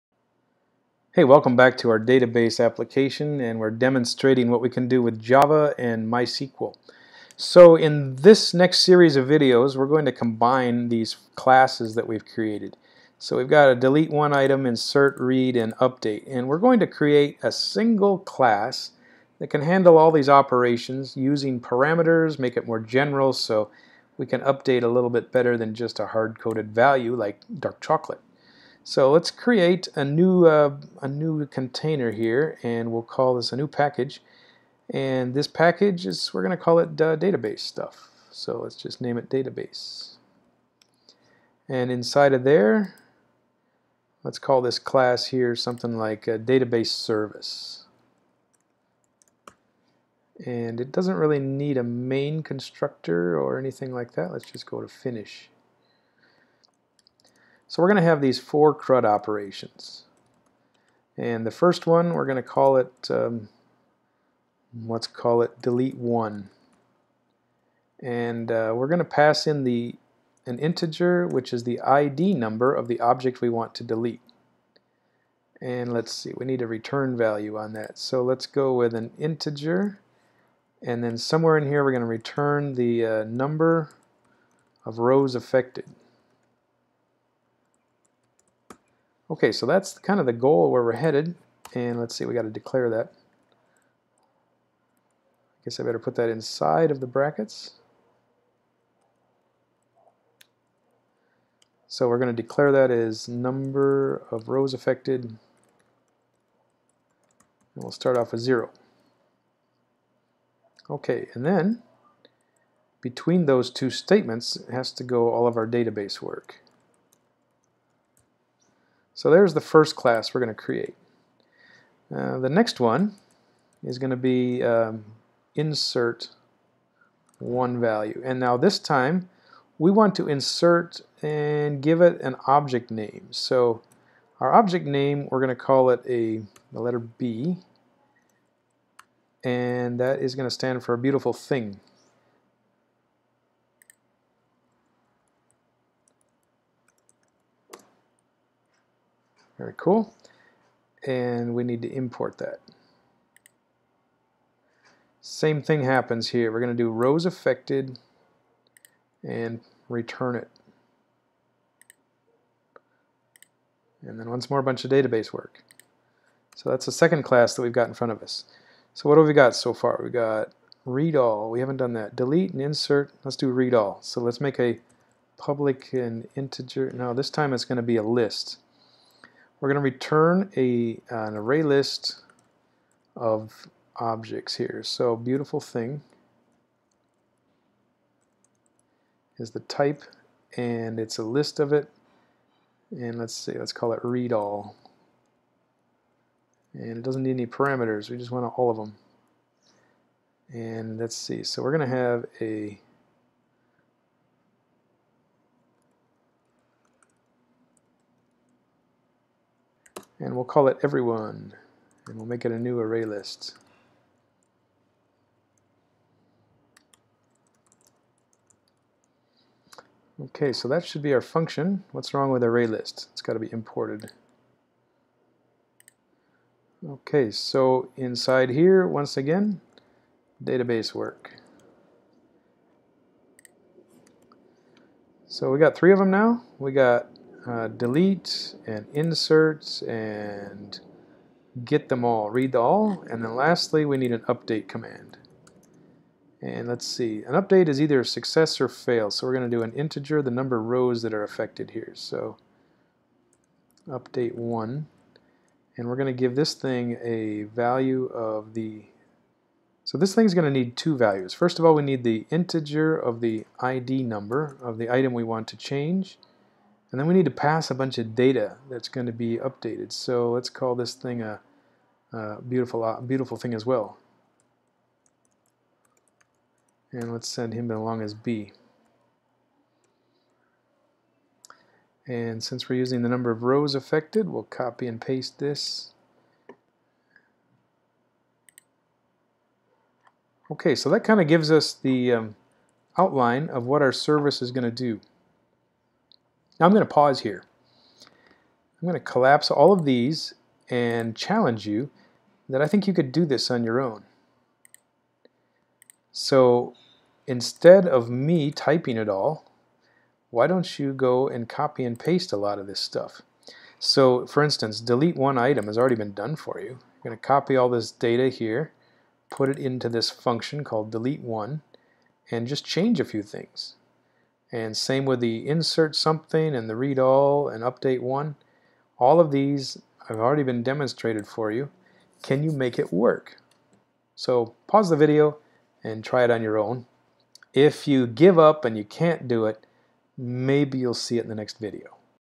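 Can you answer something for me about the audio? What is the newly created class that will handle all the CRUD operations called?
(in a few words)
database service.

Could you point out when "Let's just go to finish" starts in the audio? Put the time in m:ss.
0:54.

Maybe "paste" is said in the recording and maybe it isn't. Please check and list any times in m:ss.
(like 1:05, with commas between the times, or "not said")
4:44, 5:11.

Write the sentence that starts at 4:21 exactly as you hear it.
First of all, we need the integer of the ID number of the item we want to change.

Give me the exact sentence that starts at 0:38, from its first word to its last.
So let's just name it database.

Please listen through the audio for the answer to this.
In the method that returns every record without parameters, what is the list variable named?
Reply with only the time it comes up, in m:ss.
3:30.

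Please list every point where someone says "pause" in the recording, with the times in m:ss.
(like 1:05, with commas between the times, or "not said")
4:56, 5:34.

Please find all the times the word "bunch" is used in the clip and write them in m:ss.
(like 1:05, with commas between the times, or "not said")
2:44, 4:27.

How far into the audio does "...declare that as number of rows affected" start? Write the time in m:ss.
1:42.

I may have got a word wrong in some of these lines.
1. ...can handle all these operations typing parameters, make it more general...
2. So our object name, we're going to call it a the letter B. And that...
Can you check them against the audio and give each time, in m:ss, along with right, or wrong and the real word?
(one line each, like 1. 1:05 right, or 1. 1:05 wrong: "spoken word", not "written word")
1. 0:19 wrong: "using", not "typing"
2. 2:13 right.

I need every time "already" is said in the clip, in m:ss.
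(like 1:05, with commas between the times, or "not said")
5:15, 5:30.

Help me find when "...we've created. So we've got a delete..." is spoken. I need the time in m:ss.
0:12.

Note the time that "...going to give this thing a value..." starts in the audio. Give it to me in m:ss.
4:15.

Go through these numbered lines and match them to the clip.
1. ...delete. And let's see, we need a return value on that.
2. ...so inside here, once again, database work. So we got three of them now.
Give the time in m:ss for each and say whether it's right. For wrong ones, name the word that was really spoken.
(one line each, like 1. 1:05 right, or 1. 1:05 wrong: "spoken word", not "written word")
1. 1:13 right
2. 3:47 right.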